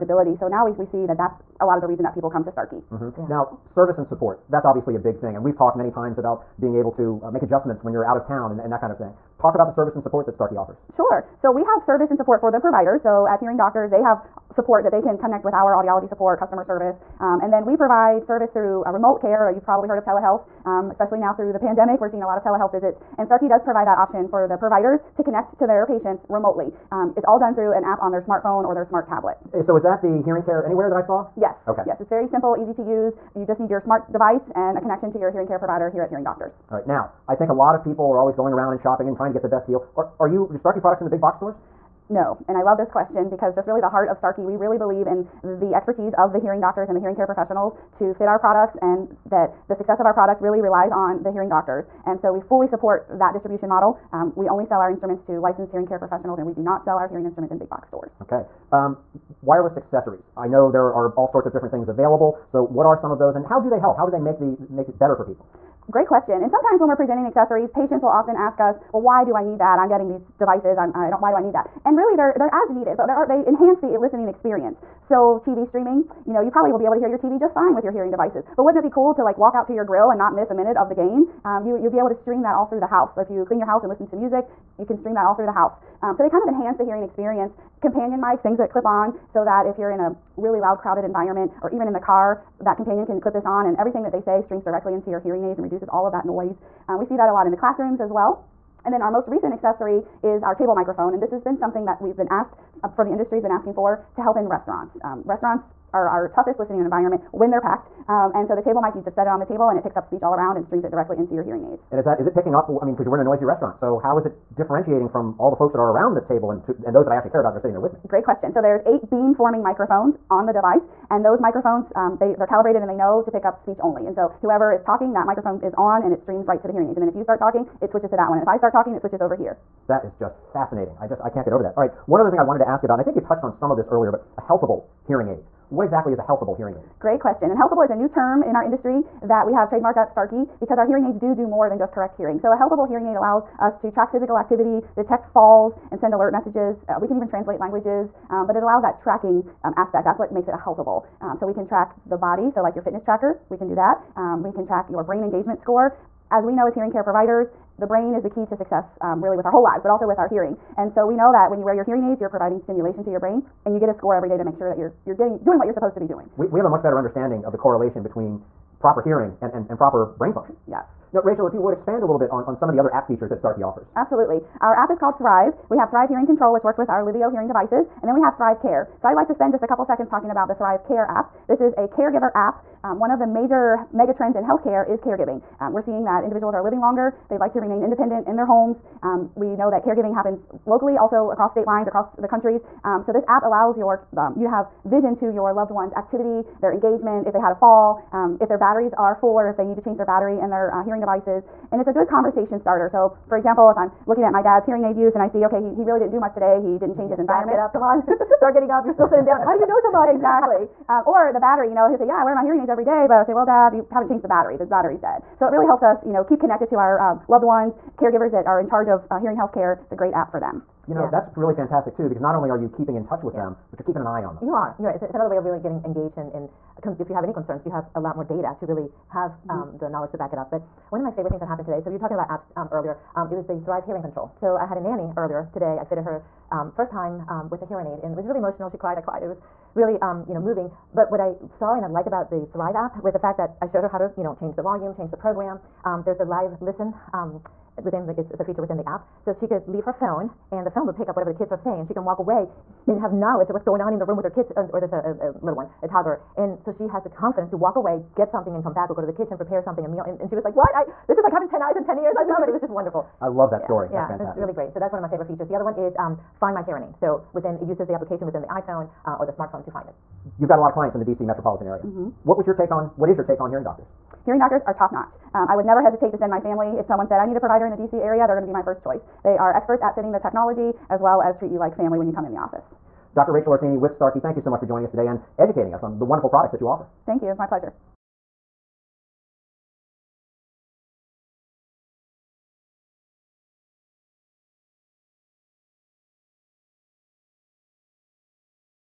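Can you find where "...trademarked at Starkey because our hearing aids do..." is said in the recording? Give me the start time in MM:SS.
02:19.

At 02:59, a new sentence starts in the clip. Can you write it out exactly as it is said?
So I'd like to spend just a couple seconds talking about the Thrive Care app.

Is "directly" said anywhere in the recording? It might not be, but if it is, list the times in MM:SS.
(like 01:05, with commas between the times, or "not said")
01:34, 01:50.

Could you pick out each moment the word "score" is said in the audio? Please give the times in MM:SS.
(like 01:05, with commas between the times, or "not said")
02:35, 02:43.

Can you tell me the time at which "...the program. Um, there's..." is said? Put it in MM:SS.
04:05.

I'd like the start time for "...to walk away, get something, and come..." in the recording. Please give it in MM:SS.
04:17.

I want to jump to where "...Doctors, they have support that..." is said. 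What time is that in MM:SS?
00:13.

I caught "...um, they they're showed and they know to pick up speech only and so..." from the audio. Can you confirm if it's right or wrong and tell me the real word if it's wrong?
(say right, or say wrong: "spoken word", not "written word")
wrong: "calibrated", not "showed".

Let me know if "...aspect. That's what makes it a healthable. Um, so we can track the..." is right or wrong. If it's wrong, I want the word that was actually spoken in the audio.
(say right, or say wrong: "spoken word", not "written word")
right.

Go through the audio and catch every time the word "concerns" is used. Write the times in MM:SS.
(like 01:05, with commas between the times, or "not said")
03:47.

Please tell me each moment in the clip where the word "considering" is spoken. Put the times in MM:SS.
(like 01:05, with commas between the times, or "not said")
not said.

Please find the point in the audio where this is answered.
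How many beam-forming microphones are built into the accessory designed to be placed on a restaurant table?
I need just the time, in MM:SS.
01:58.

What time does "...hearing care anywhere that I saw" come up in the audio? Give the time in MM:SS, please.
00:30.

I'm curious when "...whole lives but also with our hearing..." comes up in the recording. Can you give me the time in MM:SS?
02:39.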